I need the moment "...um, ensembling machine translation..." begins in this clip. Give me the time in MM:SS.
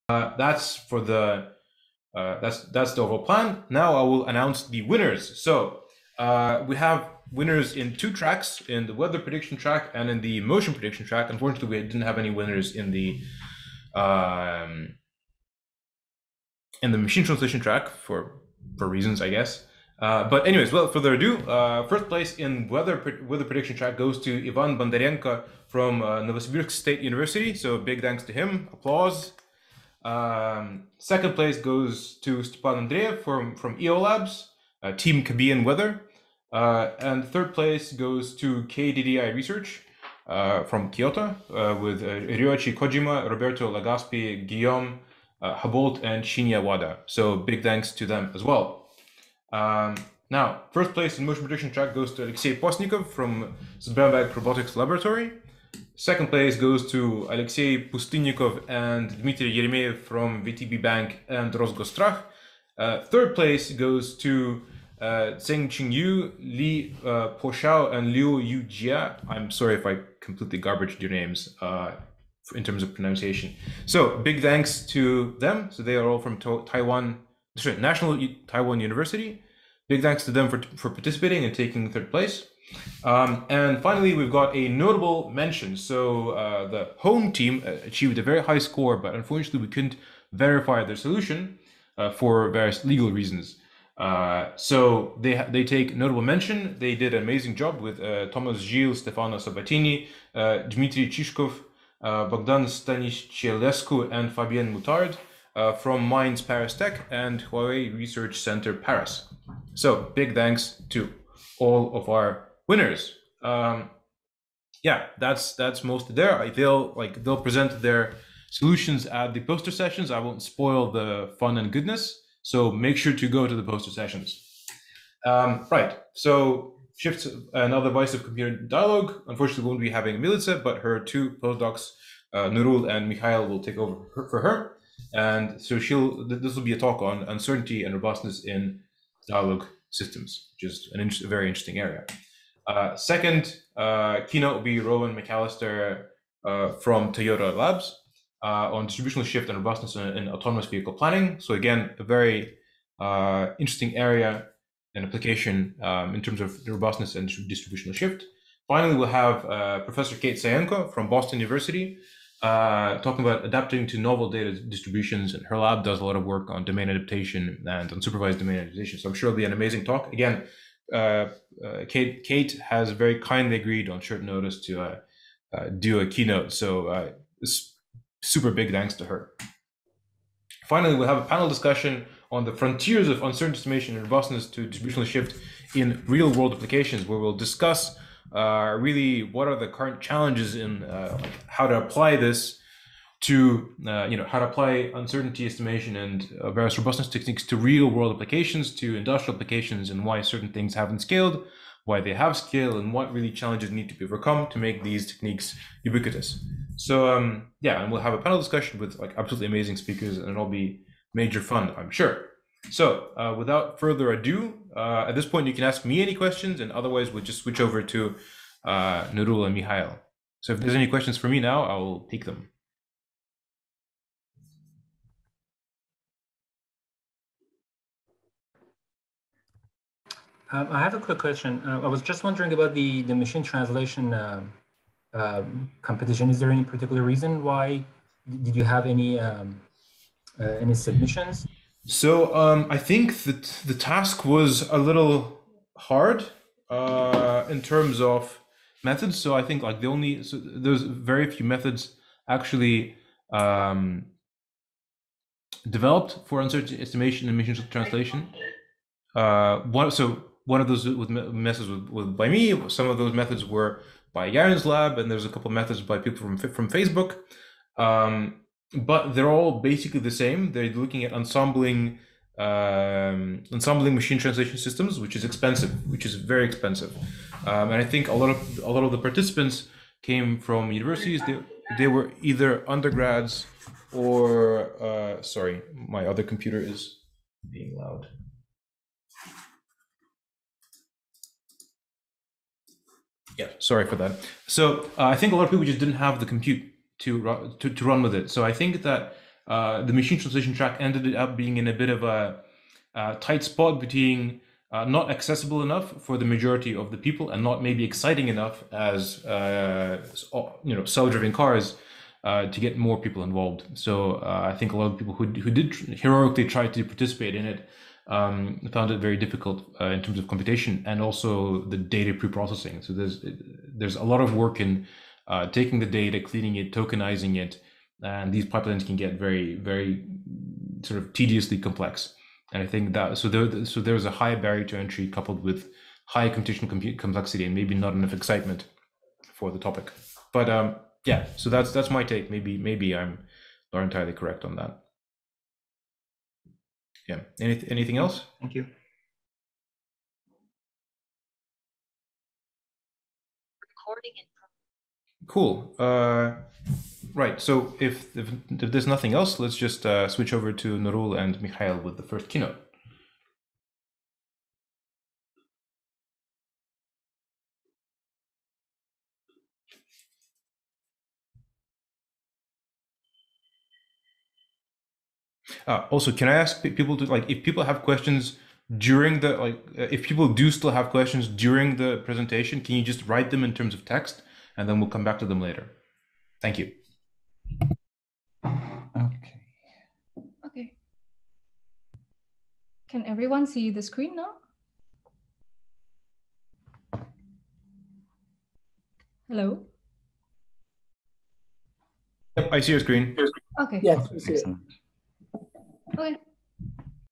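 04:32.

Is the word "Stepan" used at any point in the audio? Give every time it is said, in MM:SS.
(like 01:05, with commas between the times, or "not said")
00:32.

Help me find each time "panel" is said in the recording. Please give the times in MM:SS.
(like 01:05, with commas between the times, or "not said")
03:01, 03:28.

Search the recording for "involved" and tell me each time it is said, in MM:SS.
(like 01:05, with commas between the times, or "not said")
05:13.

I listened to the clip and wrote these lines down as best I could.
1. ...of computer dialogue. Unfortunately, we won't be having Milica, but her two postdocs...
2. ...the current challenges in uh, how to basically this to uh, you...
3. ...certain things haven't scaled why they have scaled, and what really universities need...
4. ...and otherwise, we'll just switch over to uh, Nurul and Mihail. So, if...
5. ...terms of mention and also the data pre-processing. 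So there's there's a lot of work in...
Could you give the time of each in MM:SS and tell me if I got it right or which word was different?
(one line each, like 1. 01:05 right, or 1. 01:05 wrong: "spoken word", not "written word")
1. 02:08 right
2. 03:09 wrong: "apply", not "basically"
3. 03:20 wrong: "challenges", not "universities"
4. 03:36 right
5. 05:20 wrong: "computation", not "mention".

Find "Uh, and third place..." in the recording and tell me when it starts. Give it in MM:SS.
00:36.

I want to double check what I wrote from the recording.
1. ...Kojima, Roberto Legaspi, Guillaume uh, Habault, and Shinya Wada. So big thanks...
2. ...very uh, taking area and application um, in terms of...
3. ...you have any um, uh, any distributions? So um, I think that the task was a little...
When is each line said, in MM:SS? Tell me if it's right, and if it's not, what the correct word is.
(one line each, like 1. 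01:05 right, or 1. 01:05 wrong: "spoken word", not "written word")
1. 00:42 right
2. 02:32 wrong: "interesting", not "taking"
3. 03:58 wrong: "submissions", not "distributions".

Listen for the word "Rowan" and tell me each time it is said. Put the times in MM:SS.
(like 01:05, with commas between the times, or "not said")
02:24.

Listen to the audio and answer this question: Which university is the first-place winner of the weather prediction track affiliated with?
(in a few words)
Novosibirsk State University.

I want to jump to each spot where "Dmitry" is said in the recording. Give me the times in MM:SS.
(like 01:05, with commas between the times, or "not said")
00:59, 01:40.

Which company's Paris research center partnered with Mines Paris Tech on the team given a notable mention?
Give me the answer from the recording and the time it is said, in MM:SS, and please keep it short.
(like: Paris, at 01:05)
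Huawei, at 01:47.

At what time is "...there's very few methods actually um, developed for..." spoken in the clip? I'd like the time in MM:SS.
04:10.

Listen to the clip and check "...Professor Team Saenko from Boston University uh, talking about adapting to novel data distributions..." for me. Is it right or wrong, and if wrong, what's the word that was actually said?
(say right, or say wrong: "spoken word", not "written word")
wrong: "Kate", not "Team".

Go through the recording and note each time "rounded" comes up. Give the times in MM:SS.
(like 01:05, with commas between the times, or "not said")
not said.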